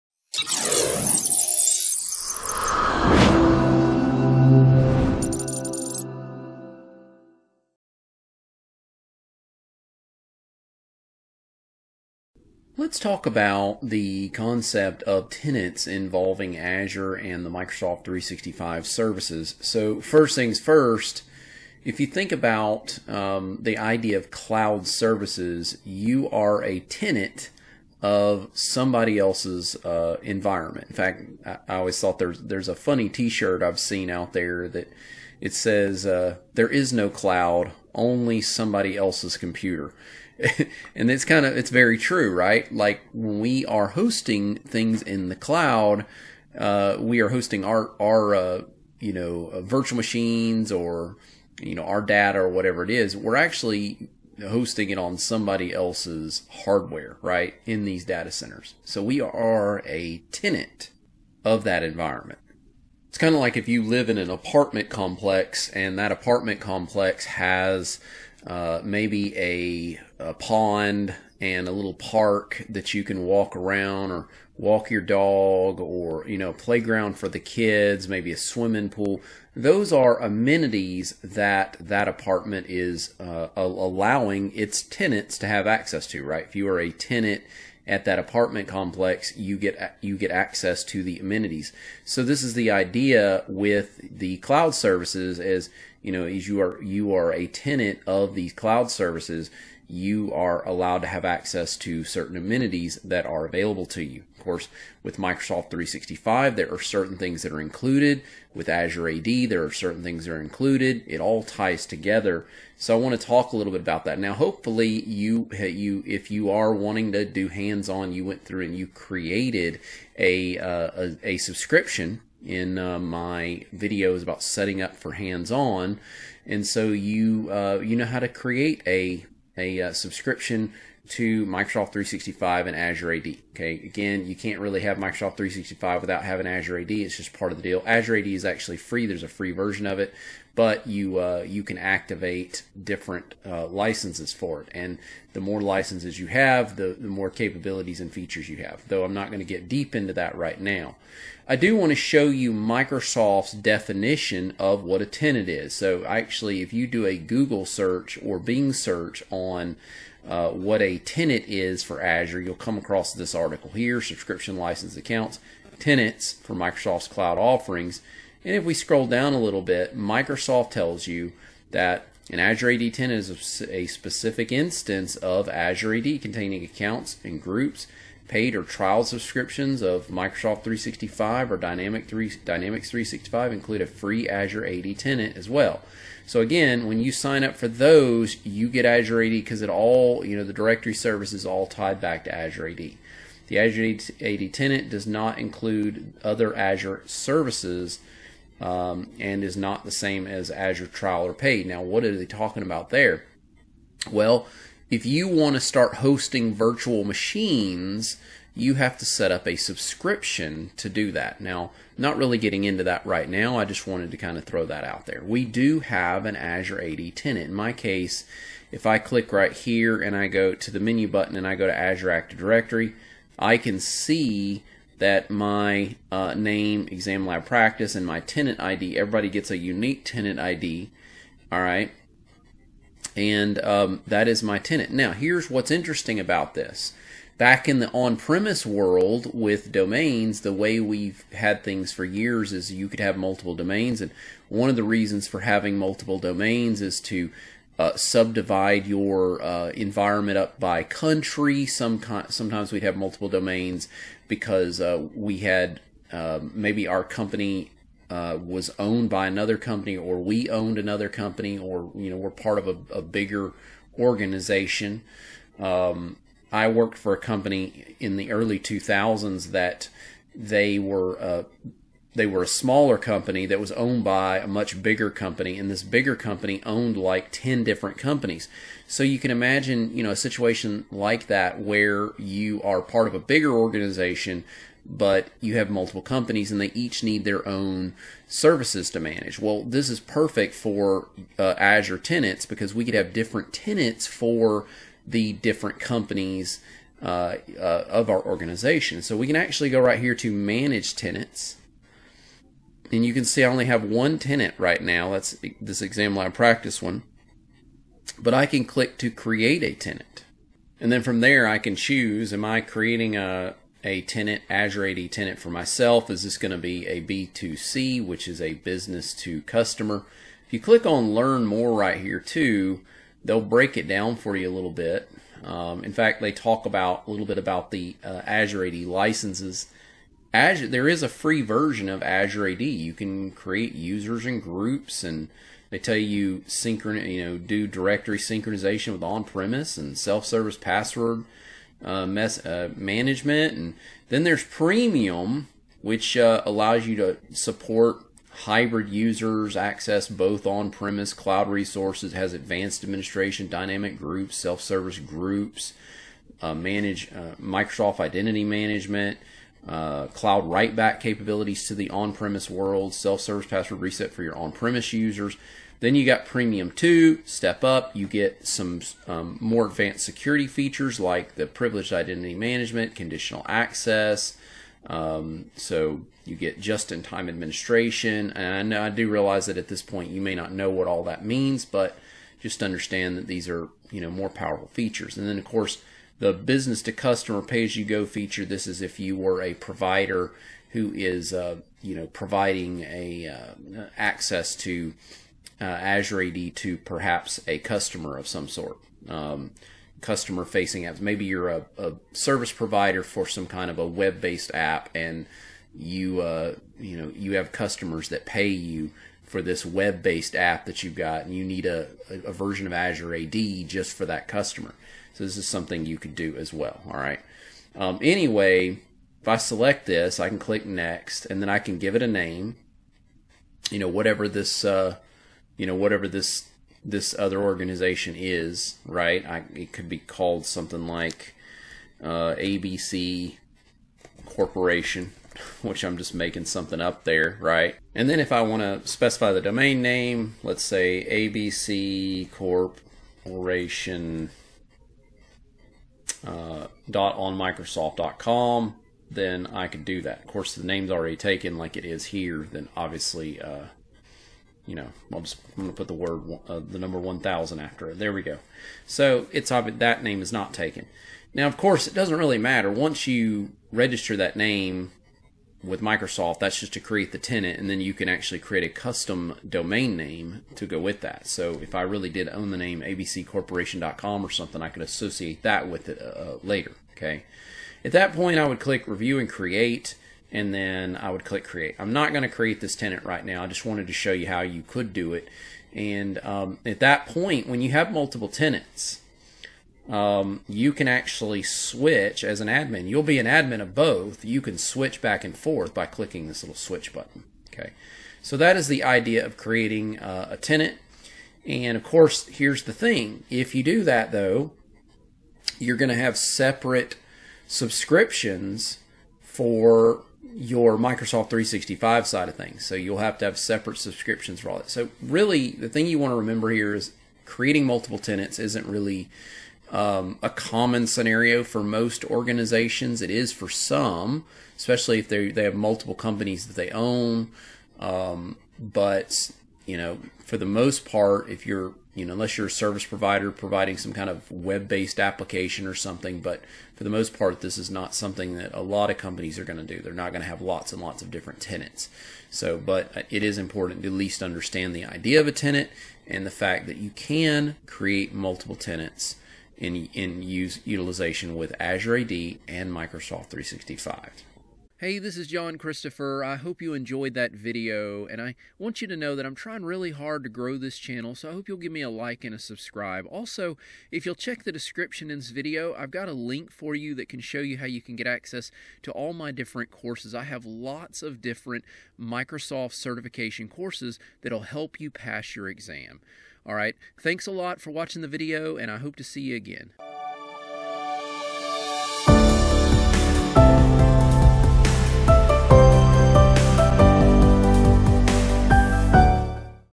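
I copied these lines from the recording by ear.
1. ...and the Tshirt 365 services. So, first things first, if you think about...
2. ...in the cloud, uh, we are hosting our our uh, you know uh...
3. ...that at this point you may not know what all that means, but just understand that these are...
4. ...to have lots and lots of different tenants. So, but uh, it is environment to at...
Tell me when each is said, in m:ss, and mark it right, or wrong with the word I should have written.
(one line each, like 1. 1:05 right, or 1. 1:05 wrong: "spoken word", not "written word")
1. 0:17 wrong: "Microsoft", not "Tshirt"
2. 0:45 right
3. 6:19 right
4. 9:00 wrong: "important", not "environment".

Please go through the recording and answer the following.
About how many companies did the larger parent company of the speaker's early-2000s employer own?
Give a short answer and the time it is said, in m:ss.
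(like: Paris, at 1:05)
10, at 4:37.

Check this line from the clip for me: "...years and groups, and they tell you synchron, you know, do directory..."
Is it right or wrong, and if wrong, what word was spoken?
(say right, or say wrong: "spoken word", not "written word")
wrong: "users", not "years".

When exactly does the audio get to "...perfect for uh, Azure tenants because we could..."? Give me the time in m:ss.
4:49.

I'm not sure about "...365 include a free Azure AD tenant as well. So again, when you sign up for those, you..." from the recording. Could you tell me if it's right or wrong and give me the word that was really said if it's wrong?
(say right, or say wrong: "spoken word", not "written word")
right.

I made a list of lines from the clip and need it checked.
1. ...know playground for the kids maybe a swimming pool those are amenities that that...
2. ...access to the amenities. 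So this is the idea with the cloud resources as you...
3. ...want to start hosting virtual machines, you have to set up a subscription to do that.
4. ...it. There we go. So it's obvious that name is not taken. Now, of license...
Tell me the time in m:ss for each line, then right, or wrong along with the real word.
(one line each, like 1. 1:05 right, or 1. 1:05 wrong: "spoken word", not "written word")
1. 1:16 right
2. 1:30 wrong: "services", not "resources"
3. 3:25 right
4. 7:37 wrong: "course", not "license".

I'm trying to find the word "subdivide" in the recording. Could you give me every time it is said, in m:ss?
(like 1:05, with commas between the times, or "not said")
4:07.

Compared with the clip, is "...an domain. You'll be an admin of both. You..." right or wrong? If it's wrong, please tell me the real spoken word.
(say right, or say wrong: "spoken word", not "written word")
wrong: "admin", not "domain".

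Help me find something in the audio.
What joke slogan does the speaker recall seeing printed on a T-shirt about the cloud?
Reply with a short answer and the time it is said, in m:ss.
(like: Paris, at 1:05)
There is no cloud only somebody else's computer, at 0:36.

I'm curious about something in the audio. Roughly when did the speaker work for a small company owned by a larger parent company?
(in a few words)
early 2000s.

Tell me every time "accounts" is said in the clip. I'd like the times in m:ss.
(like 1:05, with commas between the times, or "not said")
2:44, 2:56.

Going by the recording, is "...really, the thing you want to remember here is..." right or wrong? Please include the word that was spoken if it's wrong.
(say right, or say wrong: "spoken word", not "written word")
right.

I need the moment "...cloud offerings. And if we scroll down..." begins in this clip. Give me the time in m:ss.
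2:47.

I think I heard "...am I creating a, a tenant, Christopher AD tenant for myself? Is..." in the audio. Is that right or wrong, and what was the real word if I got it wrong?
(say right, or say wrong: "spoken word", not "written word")
wrong: "Azure", not "Christopher".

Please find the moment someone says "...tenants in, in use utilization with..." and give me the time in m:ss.
9:08.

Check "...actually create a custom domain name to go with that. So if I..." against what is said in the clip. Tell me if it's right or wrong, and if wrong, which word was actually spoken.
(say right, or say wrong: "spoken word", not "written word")
right.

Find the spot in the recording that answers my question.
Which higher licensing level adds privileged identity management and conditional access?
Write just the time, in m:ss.
6:06.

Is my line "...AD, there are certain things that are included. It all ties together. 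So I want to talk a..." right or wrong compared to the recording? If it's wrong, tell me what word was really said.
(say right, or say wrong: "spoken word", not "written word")
right.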